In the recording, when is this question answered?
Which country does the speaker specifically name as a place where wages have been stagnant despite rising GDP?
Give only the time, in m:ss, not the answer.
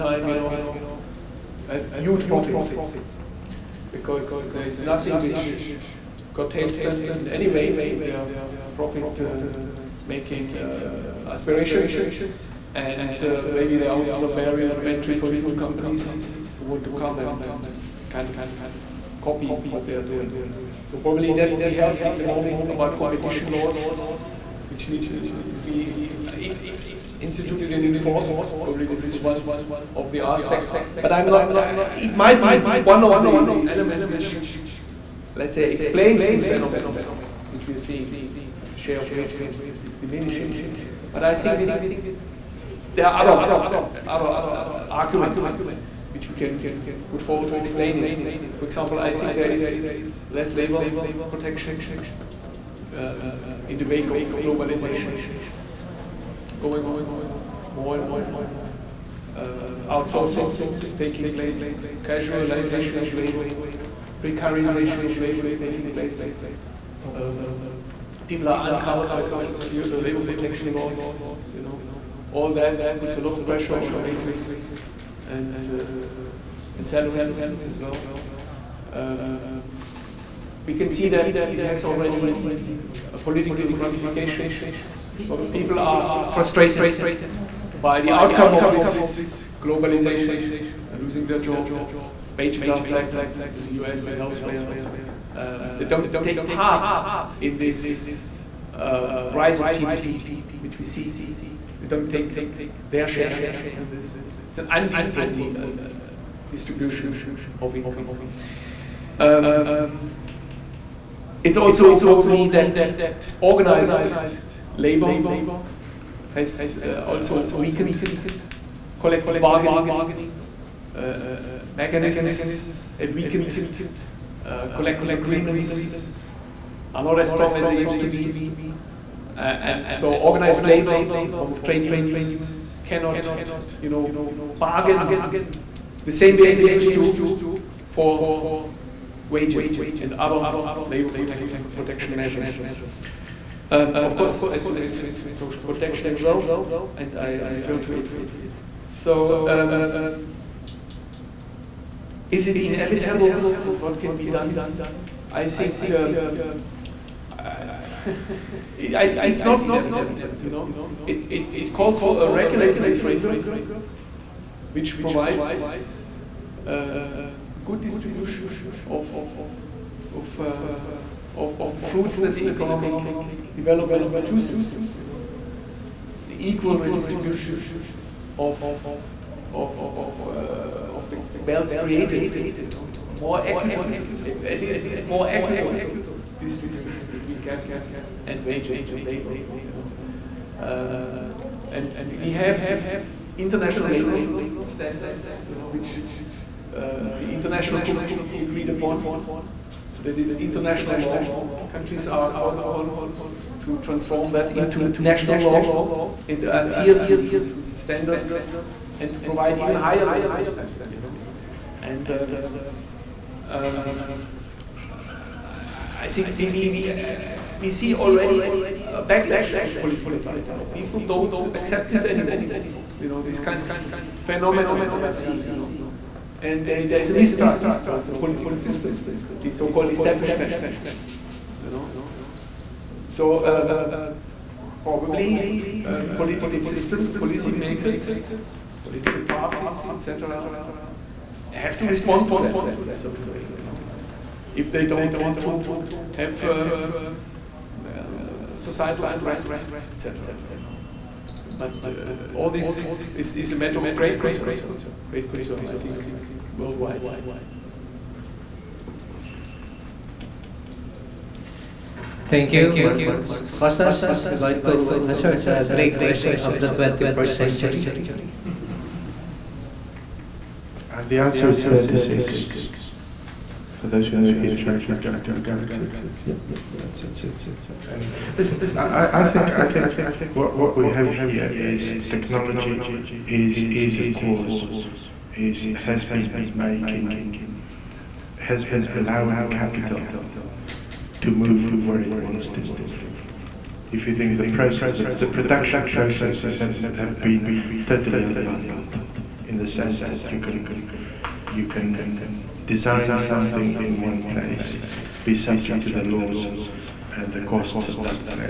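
1:33.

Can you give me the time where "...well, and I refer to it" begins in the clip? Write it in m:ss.
2:26.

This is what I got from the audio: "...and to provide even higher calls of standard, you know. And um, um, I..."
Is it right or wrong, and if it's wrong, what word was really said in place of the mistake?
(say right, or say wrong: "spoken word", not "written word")
wrong: "levels", not "calls".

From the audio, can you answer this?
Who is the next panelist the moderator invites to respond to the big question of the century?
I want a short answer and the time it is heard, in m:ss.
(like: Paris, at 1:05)
Costas, at 4:23.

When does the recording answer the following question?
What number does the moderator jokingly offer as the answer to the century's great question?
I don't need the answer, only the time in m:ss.
4:31.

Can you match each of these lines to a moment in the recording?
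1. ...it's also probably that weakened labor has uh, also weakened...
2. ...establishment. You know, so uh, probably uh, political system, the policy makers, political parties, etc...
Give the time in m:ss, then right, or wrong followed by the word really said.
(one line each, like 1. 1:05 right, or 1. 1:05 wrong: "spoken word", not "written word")
1. 1:51 wrong: "organized", not "weakened"
2. 3:49 right.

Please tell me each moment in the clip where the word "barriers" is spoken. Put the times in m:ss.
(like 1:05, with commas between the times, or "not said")
0:14.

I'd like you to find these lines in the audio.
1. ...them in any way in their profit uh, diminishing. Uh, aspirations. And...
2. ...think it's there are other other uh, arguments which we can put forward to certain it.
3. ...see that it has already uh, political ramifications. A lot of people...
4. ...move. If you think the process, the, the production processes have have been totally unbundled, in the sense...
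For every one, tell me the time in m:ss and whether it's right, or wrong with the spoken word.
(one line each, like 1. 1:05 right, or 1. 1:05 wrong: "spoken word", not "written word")
1. 0:06 wrong: "making", not "diminishing"
2. 0:41 wrong: "explain", not "certain"
3. 1:20 right
4. 4:52 right.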